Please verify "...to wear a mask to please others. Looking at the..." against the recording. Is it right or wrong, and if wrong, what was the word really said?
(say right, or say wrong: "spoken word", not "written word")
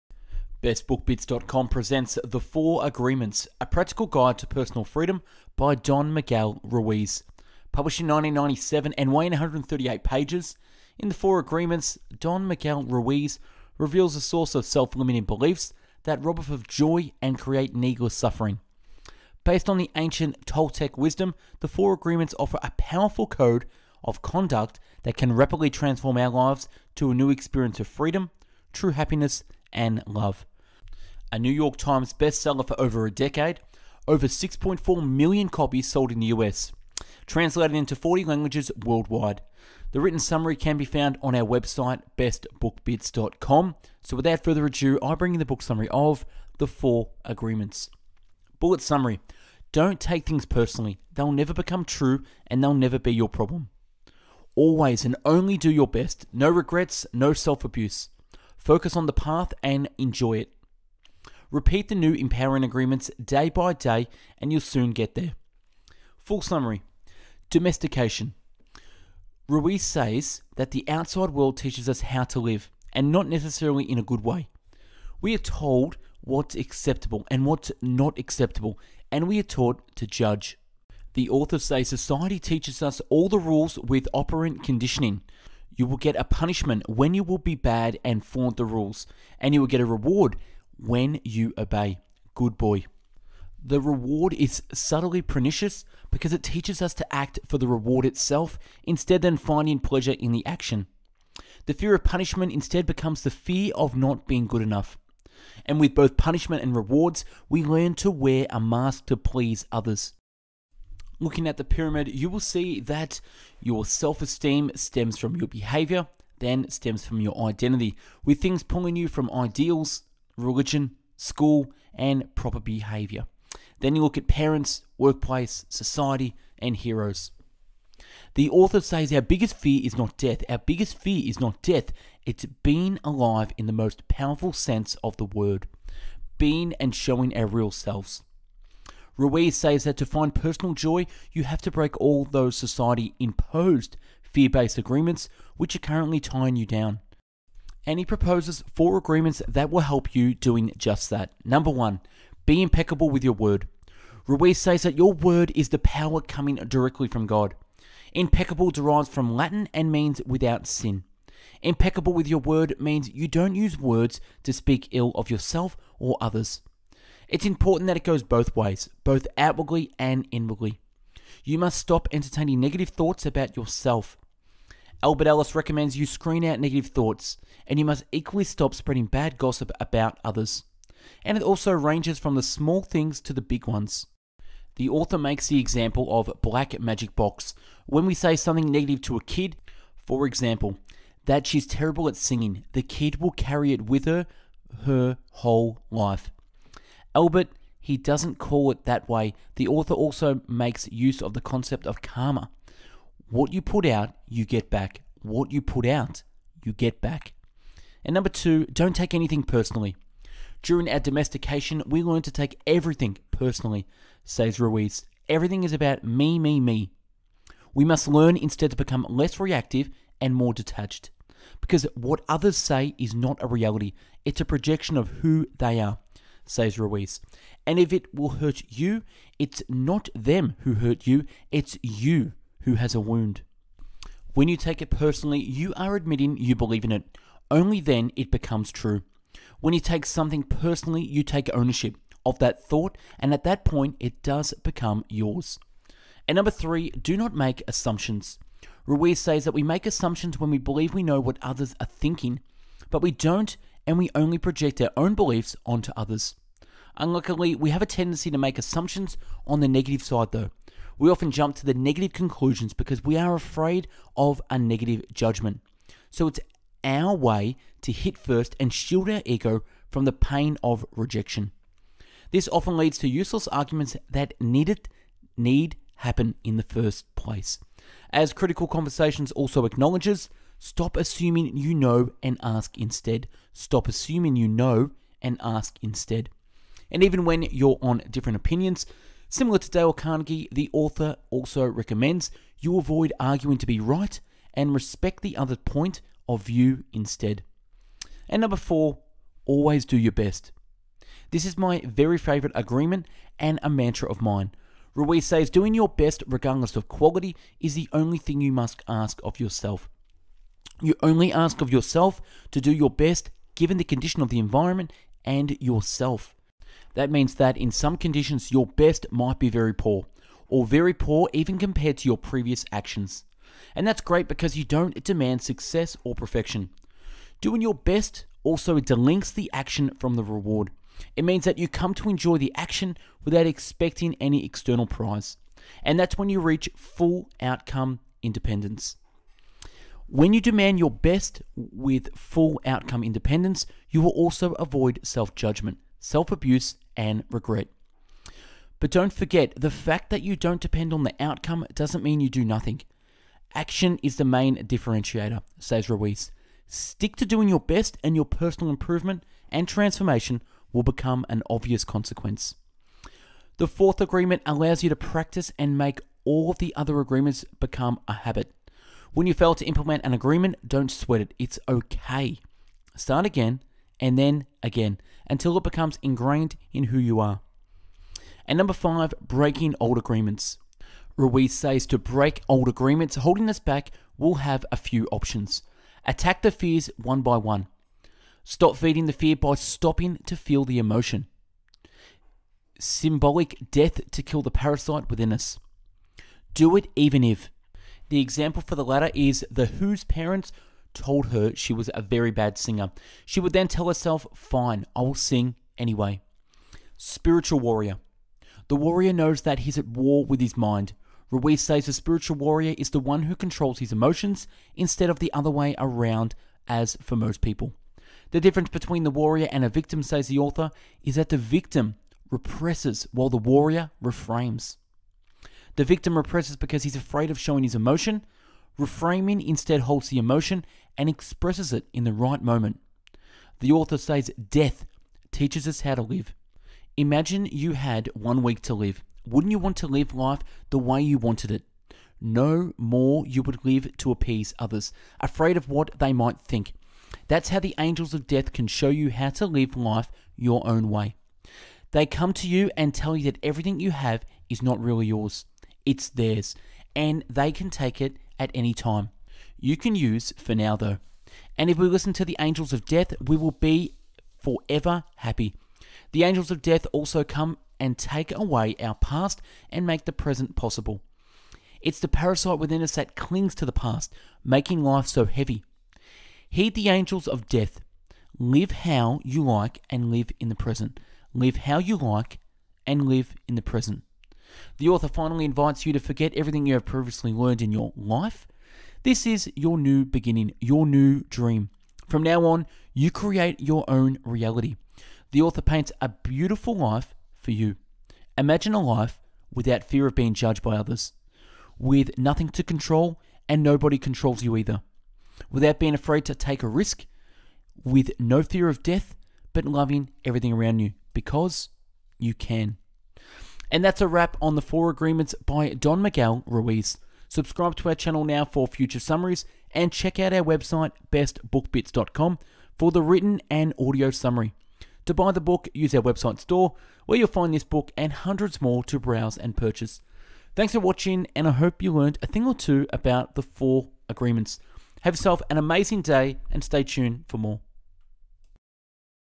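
right.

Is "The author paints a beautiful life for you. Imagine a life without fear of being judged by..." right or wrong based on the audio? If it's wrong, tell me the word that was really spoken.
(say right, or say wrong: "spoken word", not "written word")
right.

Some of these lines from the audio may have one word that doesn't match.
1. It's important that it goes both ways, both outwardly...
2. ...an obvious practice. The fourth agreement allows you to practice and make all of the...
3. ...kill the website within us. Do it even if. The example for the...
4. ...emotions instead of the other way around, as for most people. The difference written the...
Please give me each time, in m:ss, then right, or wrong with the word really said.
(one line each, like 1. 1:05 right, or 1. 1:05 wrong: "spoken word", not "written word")
1. 2:47 right
2. 6:01 wrong: "consequence", not "practice"
3. 6:34 wrong: "parasite", not "website"
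4. 6:53 wrong: "between", not "written".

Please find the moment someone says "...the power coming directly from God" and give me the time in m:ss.
2:35.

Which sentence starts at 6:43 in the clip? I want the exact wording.
She would then tell herself, Fine, I will sing anyway.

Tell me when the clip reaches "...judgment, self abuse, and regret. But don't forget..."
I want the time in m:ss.
5:45.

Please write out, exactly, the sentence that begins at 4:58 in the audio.
And number four, always do your best.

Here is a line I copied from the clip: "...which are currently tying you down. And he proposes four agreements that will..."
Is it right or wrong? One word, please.
right.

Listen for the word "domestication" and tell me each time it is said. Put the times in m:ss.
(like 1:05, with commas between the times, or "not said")
1:07, 3:30.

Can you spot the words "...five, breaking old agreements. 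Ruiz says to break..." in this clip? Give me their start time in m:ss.
6:18.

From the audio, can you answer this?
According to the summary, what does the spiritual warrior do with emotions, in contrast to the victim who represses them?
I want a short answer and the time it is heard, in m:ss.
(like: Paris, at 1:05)
reframes, at 7:04.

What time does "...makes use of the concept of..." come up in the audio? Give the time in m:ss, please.
3:20.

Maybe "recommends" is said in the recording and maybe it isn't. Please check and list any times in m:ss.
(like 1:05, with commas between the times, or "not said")
2:55, 4:51.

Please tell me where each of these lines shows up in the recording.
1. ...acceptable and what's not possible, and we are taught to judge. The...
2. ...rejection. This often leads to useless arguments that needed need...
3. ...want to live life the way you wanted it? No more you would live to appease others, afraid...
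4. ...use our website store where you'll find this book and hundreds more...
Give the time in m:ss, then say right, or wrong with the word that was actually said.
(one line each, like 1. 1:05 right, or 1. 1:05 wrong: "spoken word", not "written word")
1. 1:16 wrong: "acceptable", not "possible"
2. 4:30 right
3. 7:19 right
4. 8:45 right.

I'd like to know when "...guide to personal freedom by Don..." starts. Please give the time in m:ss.
0:04.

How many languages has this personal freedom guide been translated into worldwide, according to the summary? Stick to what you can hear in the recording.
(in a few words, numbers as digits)
40.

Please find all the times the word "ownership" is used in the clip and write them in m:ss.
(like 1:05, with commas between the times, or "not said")
4:01.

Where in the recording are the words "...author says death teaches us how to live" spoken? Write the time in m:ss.
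7:13.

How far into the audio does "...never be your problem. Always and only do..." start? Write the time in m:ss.
0:52.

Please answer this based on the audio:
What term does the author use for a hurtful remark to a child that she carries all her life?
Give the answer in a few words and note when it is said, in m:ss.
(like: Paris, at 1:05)
black magic box, at 3:06.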